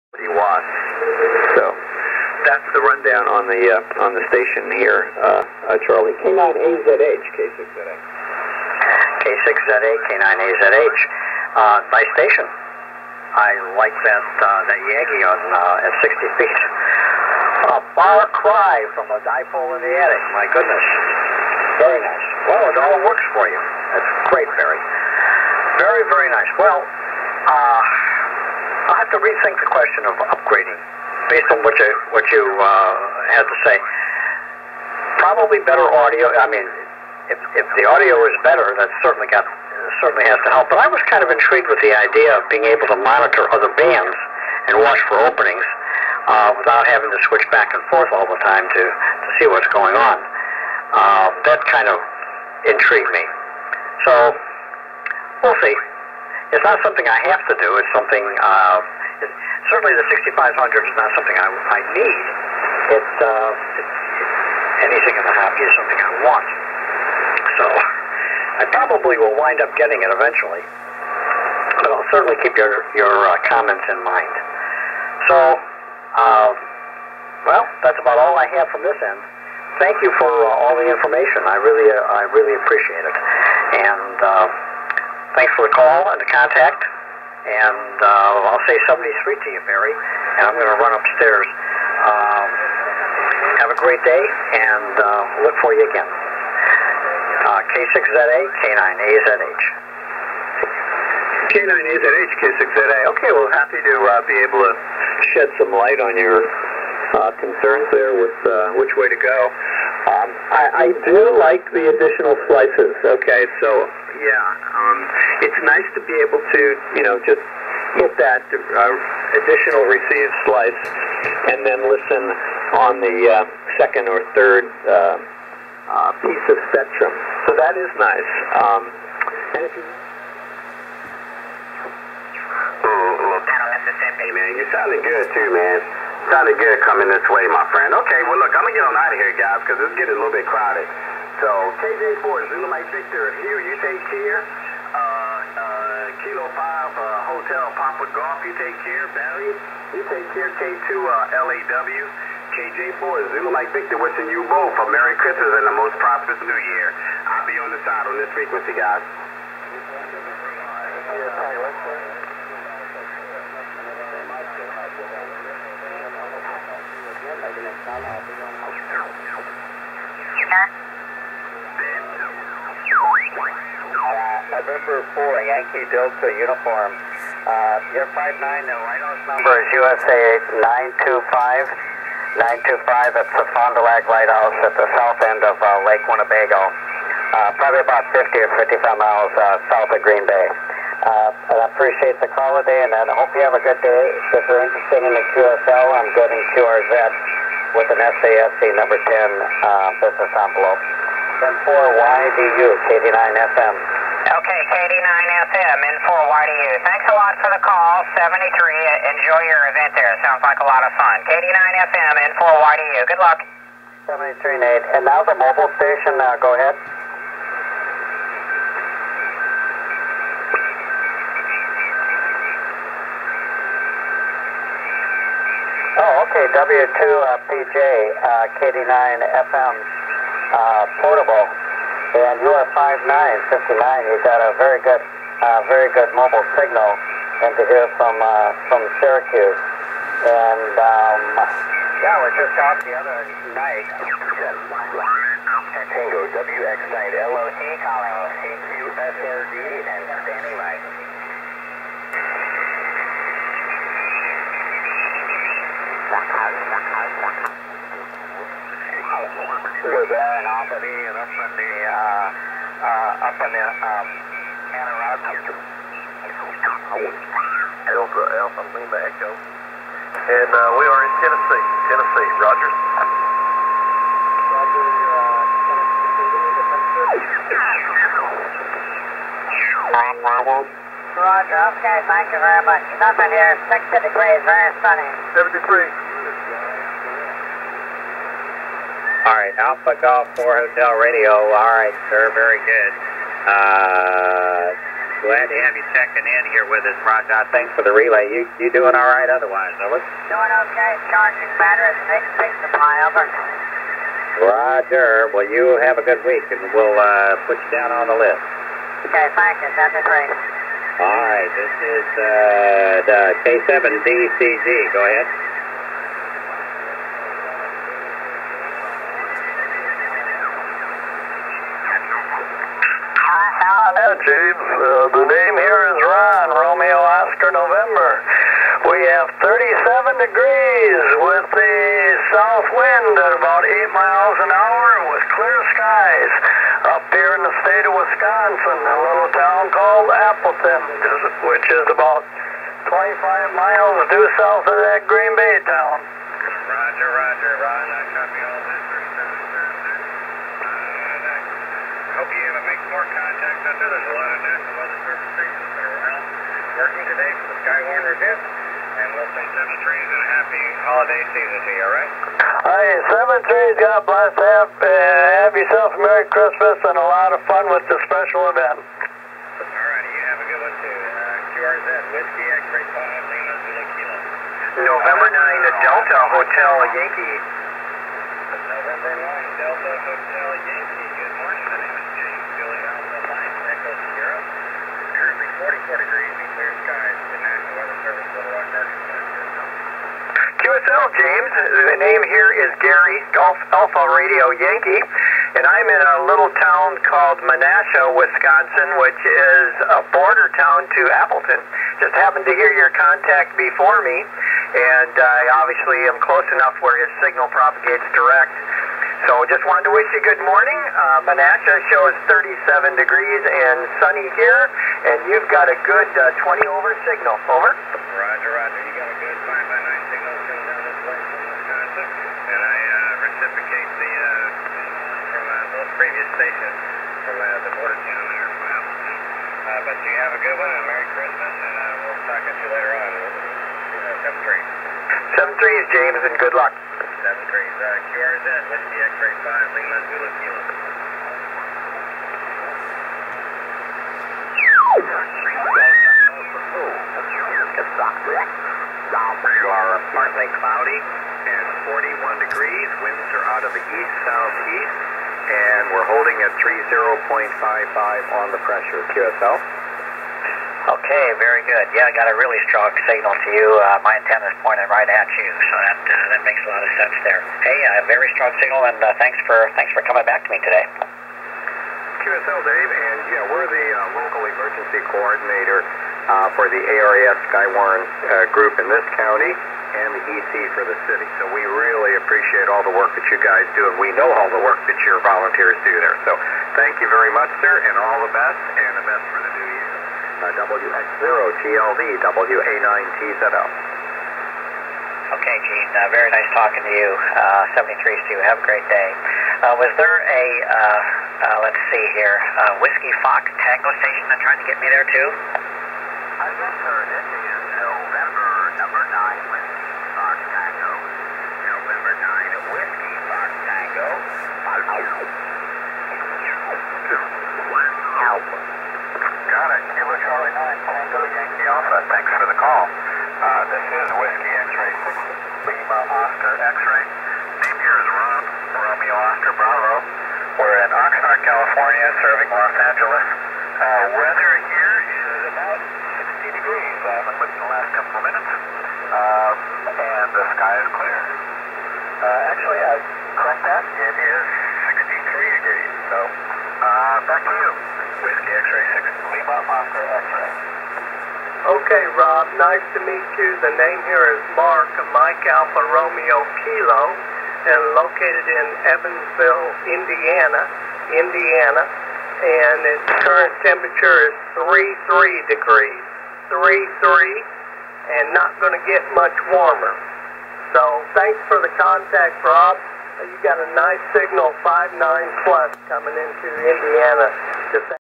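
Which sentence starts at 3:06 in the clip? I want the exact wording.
Uh, probably about 50 or 55 miles uh, south of Green Bay.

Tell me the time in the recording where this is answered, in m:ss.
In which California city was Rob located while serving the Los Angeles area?
8:50.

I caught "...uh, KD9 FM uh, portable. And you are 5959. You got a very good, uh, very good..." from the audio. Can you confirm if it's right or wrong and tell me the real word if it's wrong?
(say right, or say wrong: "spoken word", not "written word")
right.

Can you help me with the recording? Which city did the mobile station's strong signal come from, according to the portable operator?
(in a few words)
Syracuse.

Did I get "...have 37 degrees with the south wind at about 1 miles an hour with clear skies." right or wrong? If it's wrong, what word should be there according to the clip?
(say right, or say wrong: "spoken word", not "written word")
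wrong: "8", not "1".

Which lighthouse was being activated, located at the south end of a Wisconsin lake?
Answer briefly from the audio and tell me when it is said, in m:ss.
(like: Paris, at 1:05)
Fond du Lac Lighthouse, at 3:03.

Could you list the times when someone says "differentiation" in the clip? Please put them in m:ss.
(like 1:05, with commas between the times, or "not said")
not said.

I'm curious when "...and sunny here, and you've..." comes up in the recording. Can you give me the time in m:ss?
6:53.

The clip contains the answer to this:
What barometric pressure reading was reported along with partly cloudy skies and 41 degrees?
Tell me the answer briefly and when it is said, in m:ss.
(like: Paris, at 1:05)
30.55, at 7:36.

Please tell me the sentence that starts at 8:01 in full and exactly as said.
So we really appreciate all the work that you guys do, and we know all the work that your volunteers do there.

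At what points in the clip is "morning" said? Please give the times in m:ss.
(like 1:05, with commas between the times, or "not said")
6:21, 6:50.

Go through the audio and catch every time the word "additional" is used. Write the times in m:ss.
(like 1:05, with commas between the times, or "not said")
1:51, 1:59.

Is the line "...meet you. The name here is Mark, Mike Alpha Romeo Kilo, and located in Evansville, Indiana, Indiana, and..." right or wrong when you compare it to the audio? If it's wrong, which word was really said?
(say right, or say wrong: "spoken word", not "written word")
right.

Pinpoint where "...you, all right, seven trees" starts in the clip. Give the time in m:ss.
6:01.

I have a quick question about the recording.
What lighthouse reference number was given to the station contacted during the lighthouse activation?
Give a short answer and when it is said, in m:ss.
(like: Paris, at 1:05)
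USA 925, at 2:59.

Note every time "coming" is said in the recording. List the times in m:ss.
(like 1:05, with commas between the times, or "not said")
2:16, 7:00, 7:50, 9:35.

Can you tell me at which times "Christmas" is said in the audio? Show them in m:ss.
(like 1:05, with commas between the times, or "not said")
2:35, 6:06, 7:11.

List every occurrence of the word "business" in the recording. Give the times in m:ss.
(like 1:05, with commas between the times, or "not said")
3:20.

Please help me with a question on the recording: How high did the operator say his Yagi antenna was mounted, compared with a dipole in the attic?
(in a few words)
60 feet.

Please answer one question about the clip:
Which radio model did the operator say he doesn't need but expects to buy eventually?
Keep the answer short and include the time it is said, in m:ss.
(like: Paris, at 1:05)
6500, at 1:00.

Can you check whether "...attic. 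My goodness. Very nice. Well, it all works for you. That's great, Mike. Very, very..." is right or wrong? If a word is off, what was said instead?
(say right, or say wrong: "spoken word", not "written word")
wrong: "Barry", not "Mike".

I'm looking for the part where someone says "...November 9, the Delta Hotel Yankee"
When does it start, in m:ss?
6:14.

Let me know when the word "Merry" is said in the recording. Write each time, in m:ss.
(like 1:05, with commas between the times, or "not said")
2:34, 6:05, 7:10.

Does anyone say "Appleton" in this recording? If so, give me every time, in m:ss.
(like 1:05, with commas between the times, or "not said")
5:40, 6:41.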